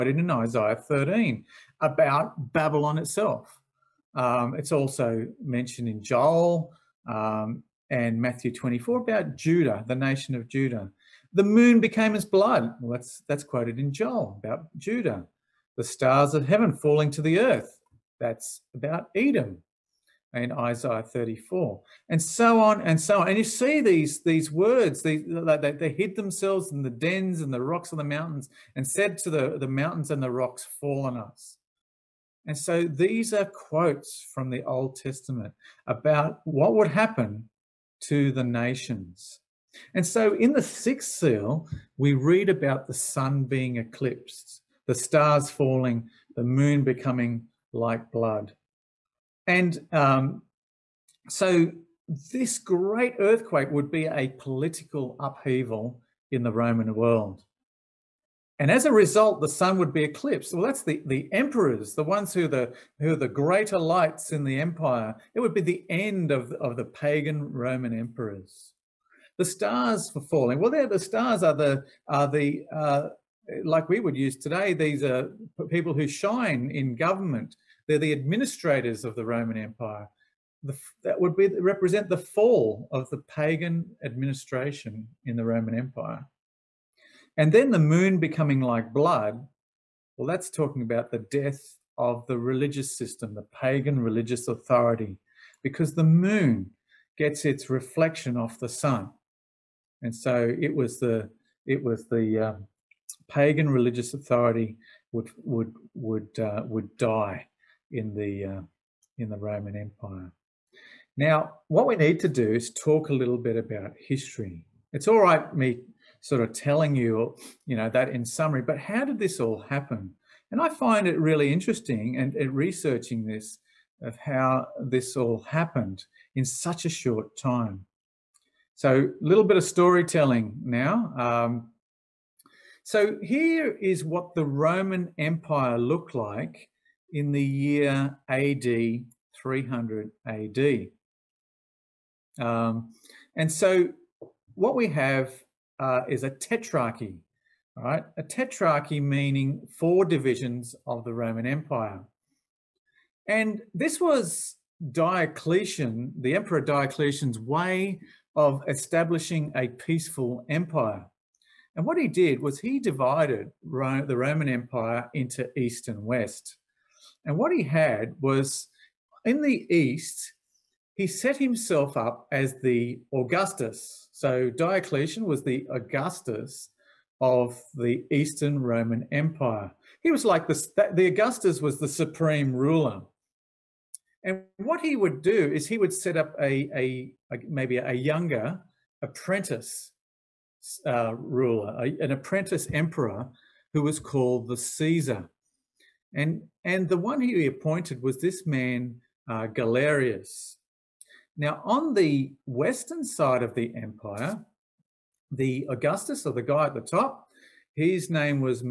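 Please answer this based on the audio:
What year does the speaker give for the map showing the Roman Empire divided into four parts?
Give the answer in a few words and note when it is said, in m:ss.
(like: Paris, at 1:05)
AD 300, at 2:18.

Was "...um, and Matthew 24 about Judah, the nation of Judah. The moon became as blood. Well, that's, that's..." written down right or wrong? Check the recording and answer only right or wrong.
right.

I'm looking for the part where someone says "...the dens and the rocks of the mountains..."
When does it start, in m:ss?
0:26.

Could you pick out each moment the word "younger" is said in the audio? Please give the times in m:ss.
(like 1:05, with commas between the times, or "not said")
3:07.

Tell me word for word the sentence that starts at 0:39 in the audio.
And so in the sixth seal, we read about the sun being eclipsed, the stars falling, the moon becoming like blood.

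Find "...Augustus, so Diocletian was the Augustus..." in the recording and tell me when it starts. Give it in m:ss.
2:53.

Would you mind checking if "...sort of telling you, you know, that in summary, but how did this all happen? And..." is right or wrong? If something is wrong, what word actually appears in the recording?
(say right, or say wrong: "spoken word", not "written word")
right.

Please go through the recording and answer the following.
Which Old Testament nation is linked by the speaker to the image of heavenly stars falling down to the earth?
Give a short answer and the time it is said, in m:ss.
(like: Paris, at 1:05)
Edom, at 0:19.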